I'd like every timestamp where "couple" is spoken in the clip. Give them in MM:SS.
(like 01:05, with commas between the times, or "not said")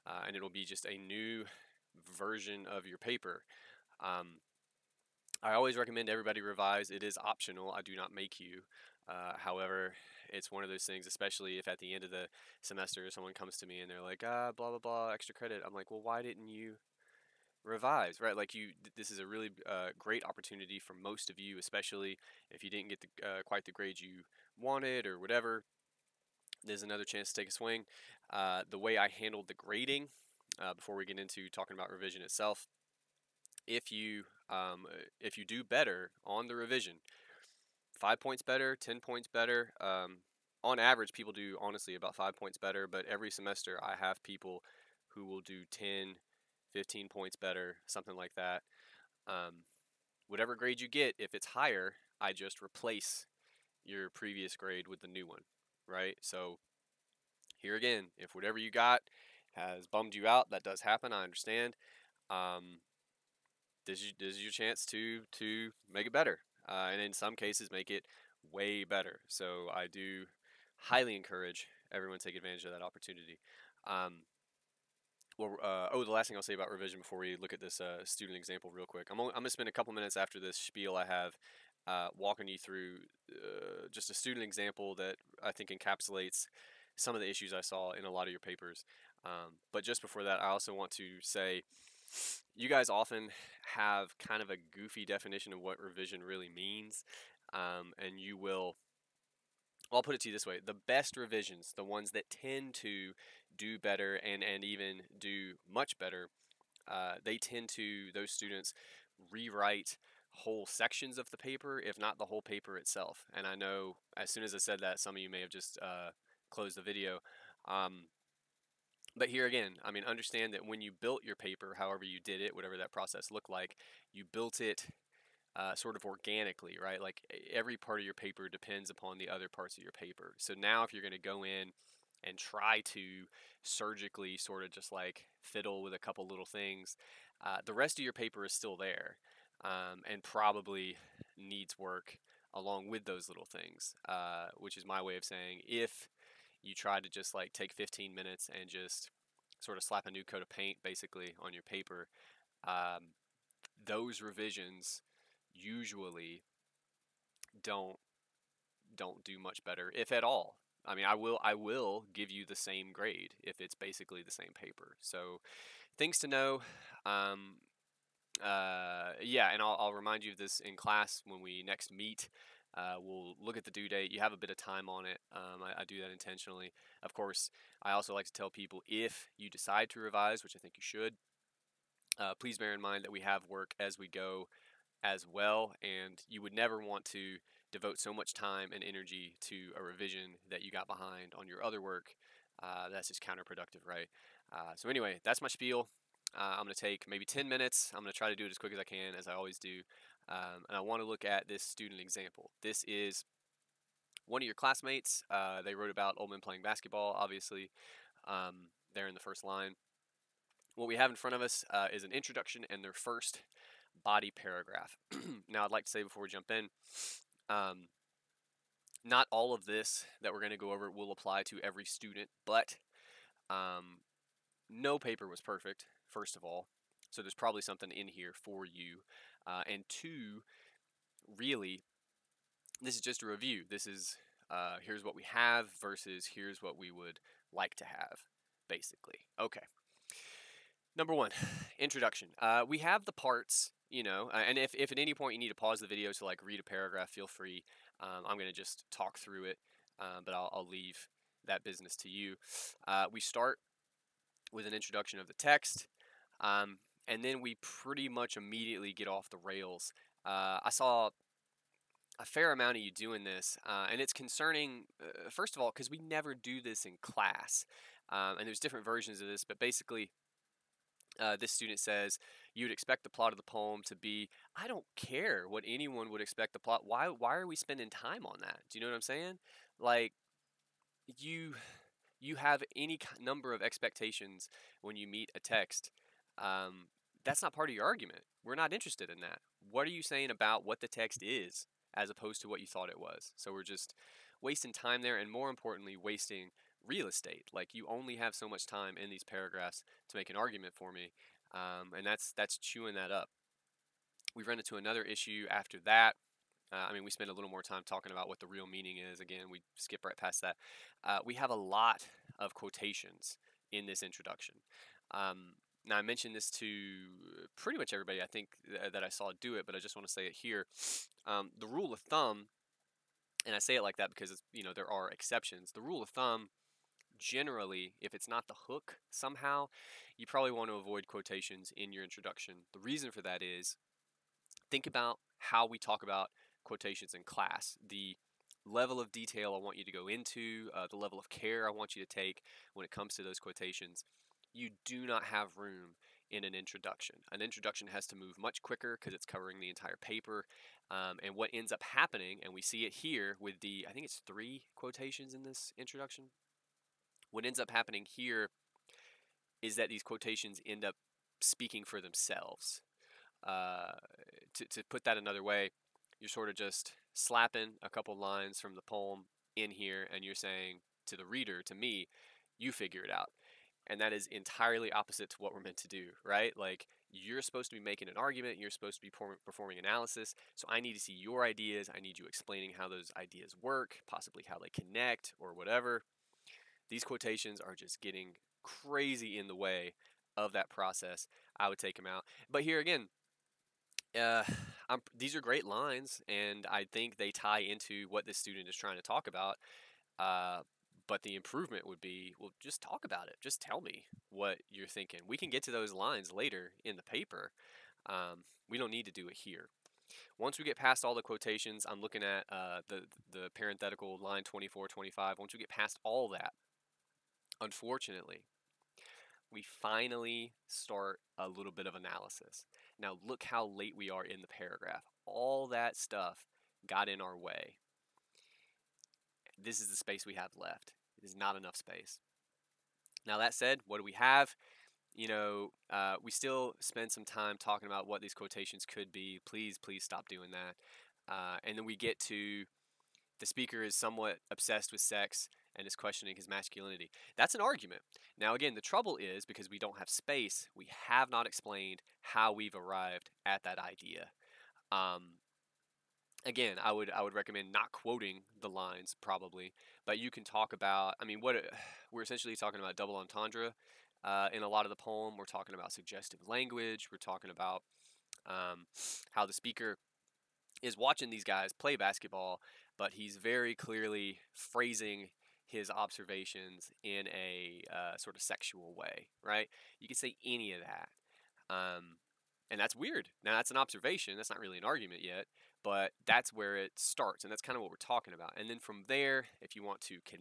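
01:19, 02:15, 06:07.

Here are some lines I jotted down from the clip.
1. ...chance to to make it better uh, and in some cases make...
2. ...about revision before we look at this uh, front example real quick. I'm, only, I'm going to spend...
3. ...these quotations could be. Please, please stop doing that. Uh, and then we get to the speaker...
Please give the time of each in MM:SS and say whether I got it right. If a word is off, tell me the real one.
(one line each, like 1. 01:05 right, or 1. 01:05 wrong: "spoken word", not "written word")
1. 01:04 right
2. 01:16 wrong: "student", not "front"
3. 07:18 right.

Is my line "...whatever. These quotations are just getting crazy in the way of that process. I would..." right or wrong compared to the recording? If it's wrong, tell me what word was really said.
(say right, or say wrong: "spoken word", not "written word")
right.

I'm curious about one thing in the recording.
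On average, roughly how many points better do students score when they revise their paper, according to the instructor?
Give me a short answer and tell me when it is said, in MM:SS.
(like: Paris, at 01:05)
5, at 00:41.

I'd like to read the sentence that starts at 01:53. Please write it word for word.
And I know as soon as I said that, some of you may have just uh, closed the video.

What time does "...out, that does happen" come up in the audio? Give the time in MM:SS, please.
01:00.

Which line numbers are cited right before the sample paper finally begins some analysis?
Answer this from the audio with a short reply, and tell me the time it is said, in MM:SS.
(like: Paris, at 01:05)
24, 25, at 06:54.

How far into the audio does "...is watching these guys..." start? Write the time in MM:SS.
07:50.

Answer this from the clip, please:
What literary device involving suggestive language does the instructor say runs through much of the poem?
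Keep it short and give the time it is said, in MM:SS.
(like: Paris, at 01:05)
double entendre, at 07:42.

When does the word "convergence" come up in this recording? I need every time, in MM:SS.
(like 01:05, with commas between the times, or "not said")
not said.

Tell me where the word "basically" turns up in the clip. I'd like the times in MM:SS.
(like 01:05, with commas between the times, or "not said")
02:30, 02:43, 03:58, 04:29.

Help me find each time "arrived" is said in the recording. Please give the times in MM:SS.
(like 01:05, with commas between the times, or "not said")
07:32.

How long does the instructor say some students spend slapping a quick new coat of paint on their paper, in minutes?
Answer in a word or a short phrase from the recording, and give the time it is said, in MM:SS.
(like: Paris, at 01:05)
15, at 02:27.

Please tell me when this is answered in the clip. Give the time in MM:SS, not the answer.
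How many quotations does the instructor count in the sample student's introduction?
05:54.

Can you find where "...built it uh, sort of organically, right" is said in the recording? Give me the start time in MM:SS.
02:04.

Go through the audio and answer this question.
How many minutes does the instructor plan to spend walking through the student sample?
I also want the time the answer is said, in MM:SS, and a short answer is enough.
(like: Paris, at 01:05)
10, at 03:17.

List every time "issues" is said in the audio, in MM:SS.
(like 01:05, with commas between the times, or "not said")
01:27, 05:05.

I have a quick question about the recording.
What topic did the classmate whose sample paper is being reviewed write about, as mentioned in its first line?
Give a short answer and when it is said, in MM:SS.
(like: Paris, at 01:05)
old men playing basketball, at 03:26.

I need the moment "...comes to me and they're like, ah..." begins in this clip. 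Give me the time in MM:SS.
00:13.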